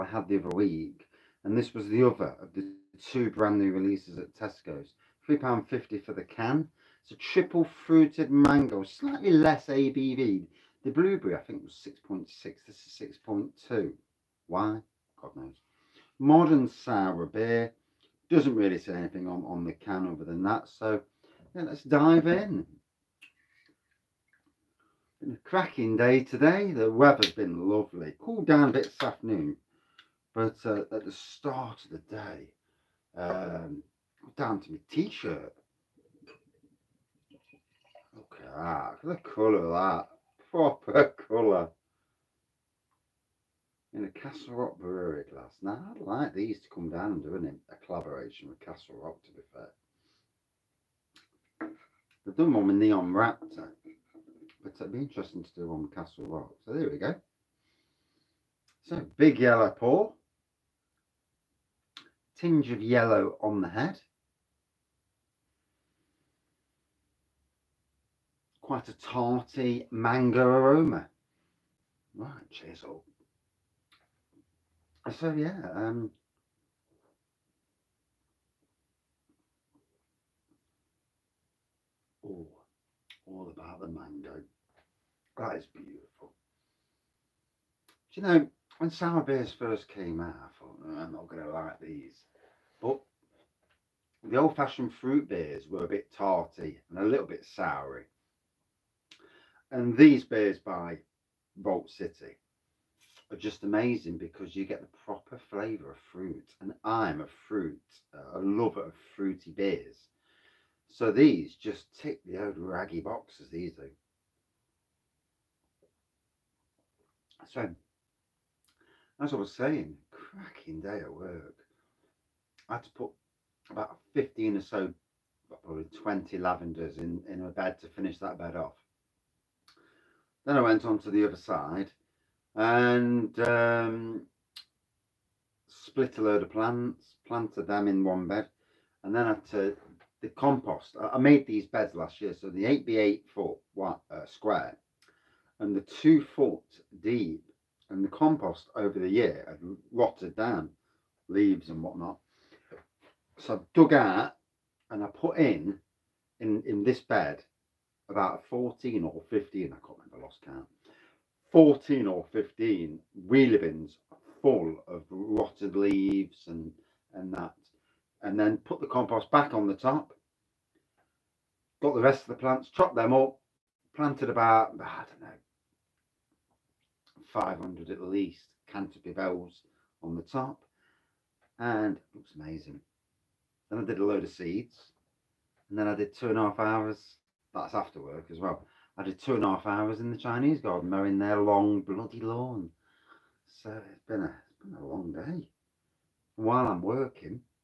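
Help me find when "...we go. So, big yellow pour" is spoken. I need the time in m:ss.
0:56.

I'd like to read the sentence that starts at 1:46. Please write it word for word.
And I'm a fruit, uh, a lover of fruity beers.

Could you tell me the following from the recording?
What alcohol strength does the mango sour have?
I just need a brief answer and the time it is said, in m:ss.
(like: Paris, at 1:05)
6.2, at 0:13.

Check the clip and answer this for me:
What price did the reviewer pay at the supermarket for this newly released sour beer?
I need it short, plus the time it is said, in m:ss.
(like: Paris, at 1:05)
£3.50, at 0:05.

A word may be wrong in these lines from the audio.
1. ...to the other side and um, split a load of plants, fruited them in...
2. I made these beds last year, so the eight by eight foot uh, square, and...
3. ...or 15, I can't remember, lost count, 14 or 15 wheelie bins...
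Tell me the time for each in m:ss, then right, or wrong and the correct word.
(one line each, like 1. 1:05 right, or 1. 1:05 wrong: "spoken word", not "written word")
1. 2:10 wrong: "planted", not "fruited"
2. 2:20 right
3. 2:39 right.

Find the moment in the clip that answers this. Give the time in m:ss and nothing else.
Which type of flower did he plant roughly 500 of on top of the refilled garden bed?
2:58.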